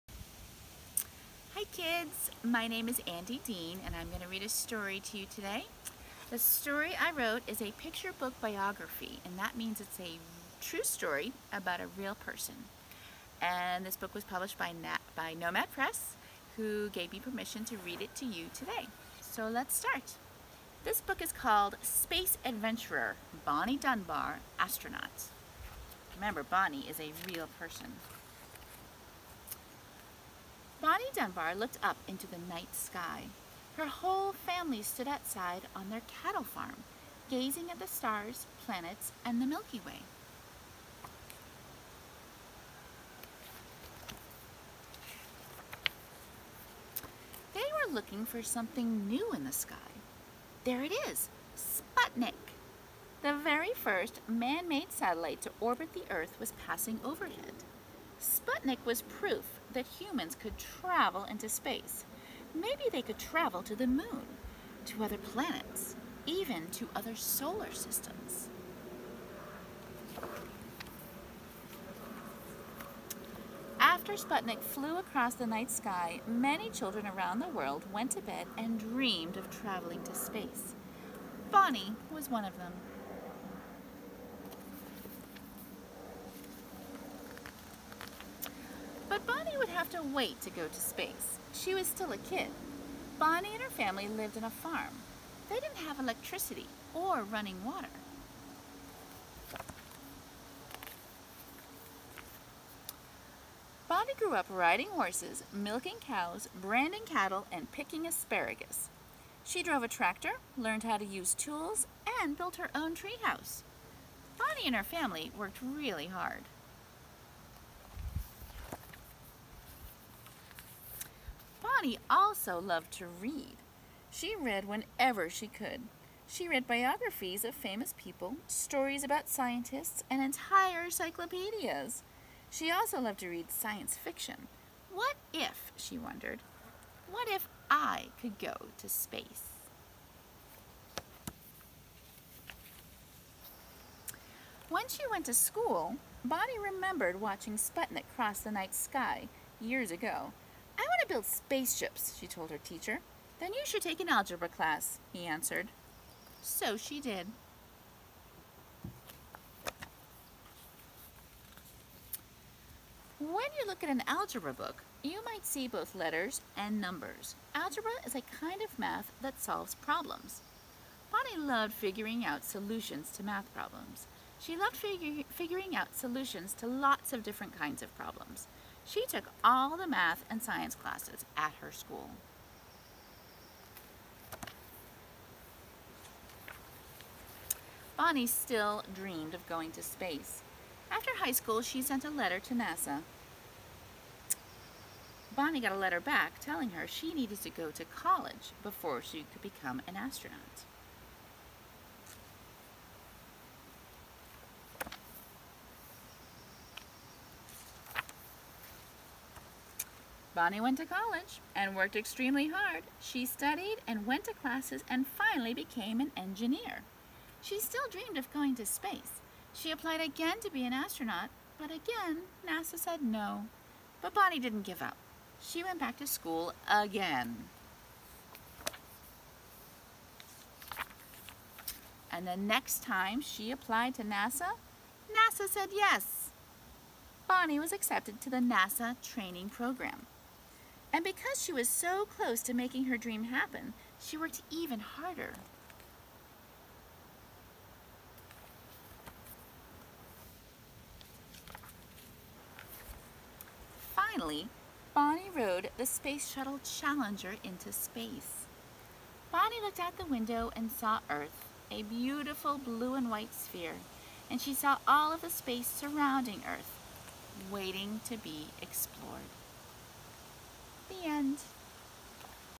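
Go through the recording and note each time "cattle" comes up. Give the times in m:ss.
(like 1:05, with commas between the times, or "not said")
0:36, 1:47.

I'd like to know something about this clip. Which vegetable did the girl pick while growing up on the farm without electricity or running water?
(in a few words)
asparagus.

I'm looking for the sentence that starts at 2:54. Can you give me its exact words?
She loved figu figuring out solutions to lots of different kinds of problems.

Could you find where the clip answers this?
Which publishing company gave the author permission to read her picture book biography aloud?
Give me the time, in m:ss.
0:15.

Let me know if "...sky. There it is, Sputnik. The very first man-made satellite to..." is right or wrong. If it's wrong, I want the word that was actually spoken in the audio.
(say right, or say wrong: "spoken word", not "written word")
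right.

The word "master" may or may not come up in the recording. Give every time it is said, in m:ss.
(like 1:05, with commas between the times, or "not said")
not said.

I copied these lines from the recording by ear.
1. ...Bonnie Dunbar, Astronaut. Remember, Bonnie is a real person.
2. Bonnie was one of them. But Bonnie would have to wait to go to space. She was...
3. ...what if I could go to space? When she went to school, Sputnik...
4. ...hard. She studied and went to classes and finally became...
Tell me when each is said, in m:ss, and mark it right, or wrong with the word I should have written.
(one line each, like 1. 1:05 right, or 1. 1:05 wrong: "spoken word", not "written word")
1. 0:23 right
2. 1:21 right
3. 2:17 wrong: "Bonnie", not "Sputnik"
4. 3:32 right.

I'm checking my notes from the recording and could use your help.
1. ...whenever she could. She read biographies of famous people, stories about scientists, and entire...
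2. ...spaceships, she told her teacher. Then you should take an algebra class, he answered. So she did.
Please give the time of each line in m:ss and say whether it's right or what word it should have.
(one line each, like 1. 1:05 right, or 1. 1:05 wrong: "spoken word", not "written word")
1. 2:04 right
2. 2:31 right.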